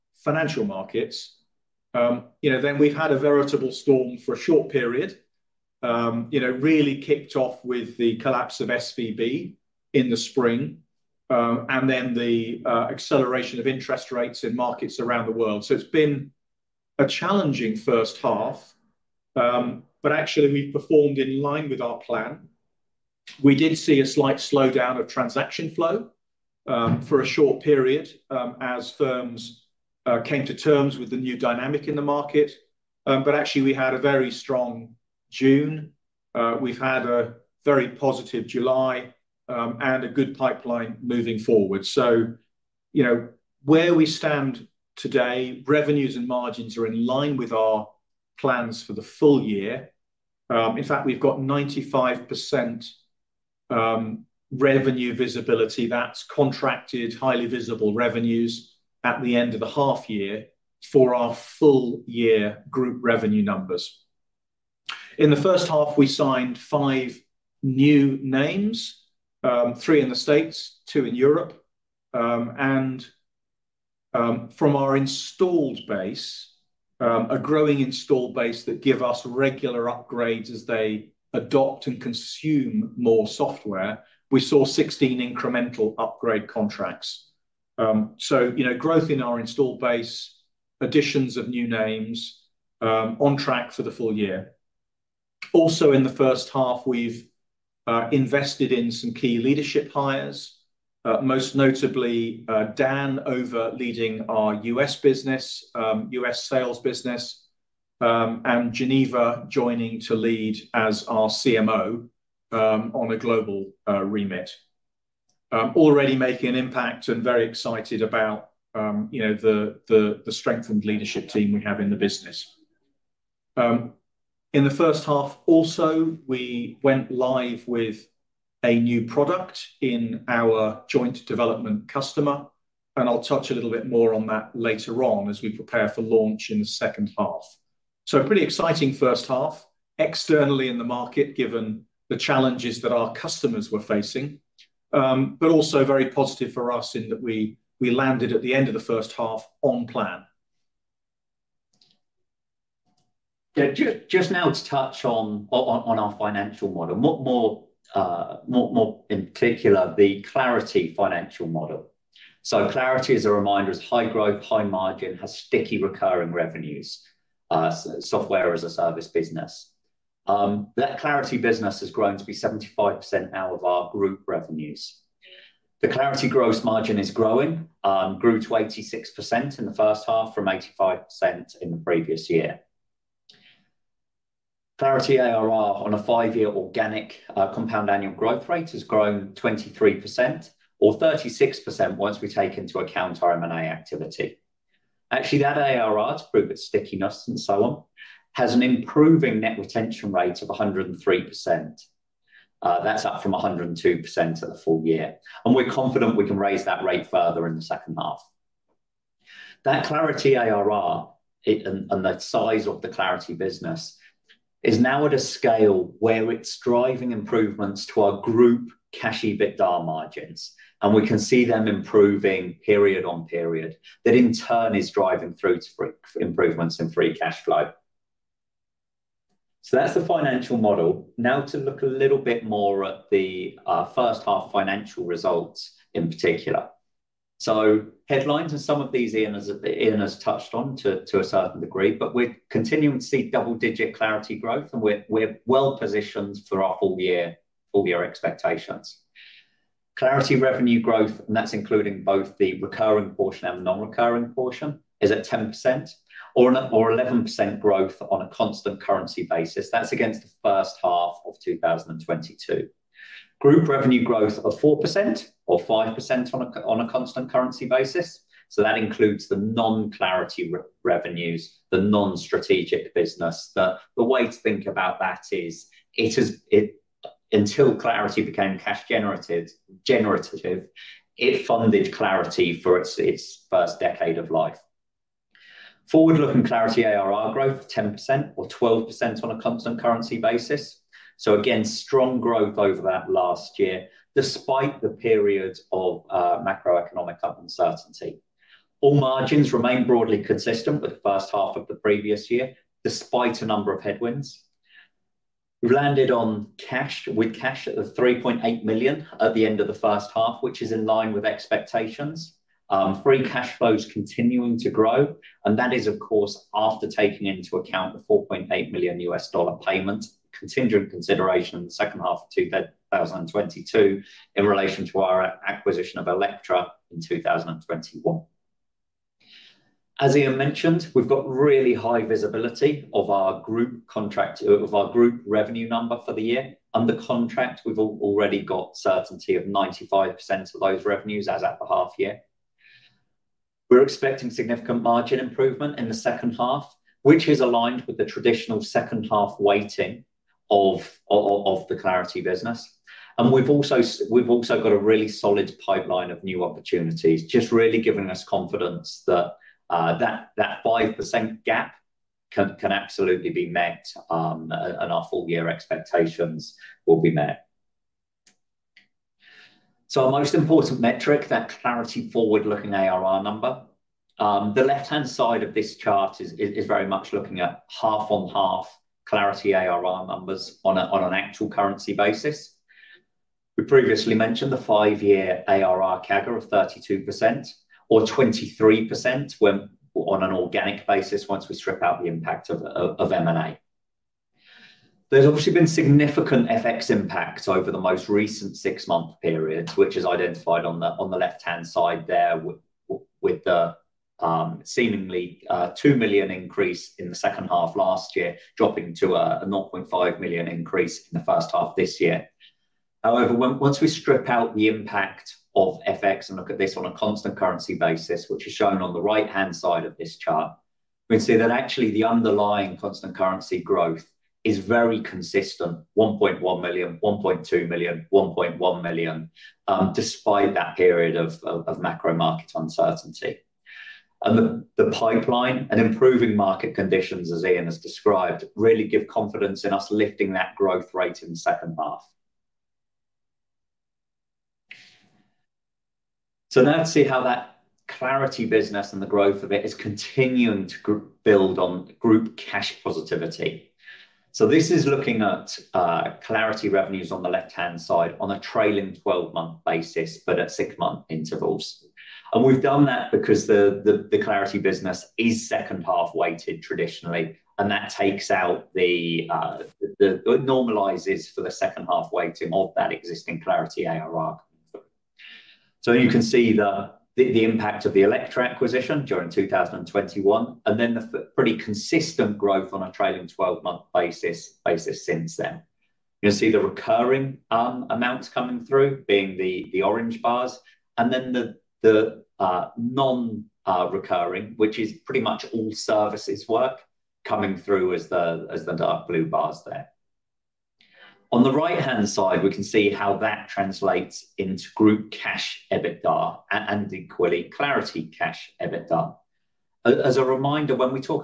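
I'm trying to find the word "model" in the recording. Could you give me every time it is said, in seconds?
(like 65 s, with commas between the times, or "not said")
156 s, 161 s, 230 s.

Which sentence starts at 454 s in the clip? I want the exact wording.
So This is looking at uh, Clarity revenues on the left-hand side on a trailing 12-month basis, but at six-month intervals.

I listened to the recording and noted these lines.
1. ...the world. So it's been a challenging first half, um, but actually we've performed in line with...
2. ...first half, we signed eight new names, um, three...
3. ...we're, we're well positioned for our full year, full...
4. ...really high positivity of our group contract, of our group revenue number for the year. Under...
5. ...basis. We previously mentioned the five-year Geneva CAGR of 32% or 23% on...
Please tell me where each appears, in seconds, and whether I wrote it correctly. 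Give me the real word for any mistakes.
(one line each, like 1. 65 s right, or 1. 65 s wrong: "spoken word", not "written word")
1. 15 s right
2. 65 s wrong: "five", not "eight"
3. 244 s right
4. 331 s wrong: "visibility", not "positivity"
5. 381 s wrong: "ARR", not "Geneva".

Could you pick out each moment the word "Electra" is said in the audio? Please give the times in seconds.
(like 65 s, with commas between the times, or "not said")
326 s, 478 s.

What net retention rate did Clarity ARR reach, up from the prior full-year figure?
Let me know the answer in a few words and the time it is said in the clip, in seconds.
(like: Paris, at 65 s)
103%, at 200 s.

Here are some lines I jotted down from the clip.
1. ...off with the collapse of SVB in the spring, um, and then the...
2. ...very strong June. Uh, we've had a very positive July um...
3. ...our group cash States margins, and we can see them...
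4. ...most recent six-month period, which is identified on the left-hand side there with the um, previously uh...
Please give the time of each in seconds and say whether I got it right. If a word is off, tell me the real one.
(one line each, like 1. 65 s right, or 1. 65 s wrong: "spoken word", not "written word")
1. 7 s right
2. 33 s right
3. 218 s wrong: "EBITDA", not "States"
4. 397 s wrong: "seemingly", not "previously".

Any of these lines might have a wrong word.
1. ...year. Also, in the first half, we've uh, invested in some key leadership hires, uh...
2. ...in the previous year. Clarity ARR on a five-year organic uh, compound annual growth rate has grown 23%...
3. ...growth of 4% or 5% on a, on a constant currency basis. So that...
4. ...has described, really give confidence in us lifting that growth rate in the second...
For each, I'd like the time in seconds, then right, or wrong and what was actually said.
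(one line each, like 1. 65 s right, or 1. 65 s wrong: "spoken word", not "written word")
1. 94 s right
2. 181 s right
3. 264 s right
4. 437 s right.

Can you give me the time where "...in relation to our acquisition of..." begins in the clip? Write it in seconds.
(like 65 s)
324 s.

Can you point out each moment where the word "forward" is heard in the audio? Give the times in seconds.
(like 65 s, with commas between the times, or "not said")
41 s, 285 s, 372 s.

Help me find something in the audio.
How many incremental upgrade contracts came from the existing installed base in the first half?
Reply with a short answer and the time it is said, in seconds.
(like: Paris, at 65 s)
16, at 84 s.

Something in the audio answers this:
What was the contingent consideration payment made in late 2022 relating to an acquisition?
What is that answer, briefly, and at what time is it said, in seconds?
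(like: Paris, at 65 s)
$4.8 million, at 318 s.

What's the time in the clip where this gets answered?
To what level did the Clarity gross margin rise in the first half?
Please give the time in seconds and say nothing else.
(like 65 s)
178 s.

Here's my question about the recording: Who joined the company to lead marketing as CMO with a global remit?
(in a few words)
Geneva.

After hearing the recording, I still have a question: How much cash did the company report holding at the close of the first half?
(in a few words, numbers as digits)
3.8 million.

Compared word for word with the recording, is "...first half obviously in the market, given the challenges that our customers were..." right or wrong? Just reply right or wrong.
wrong.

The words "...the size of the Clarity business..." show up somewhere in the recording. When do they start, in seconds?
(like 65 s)
212 s.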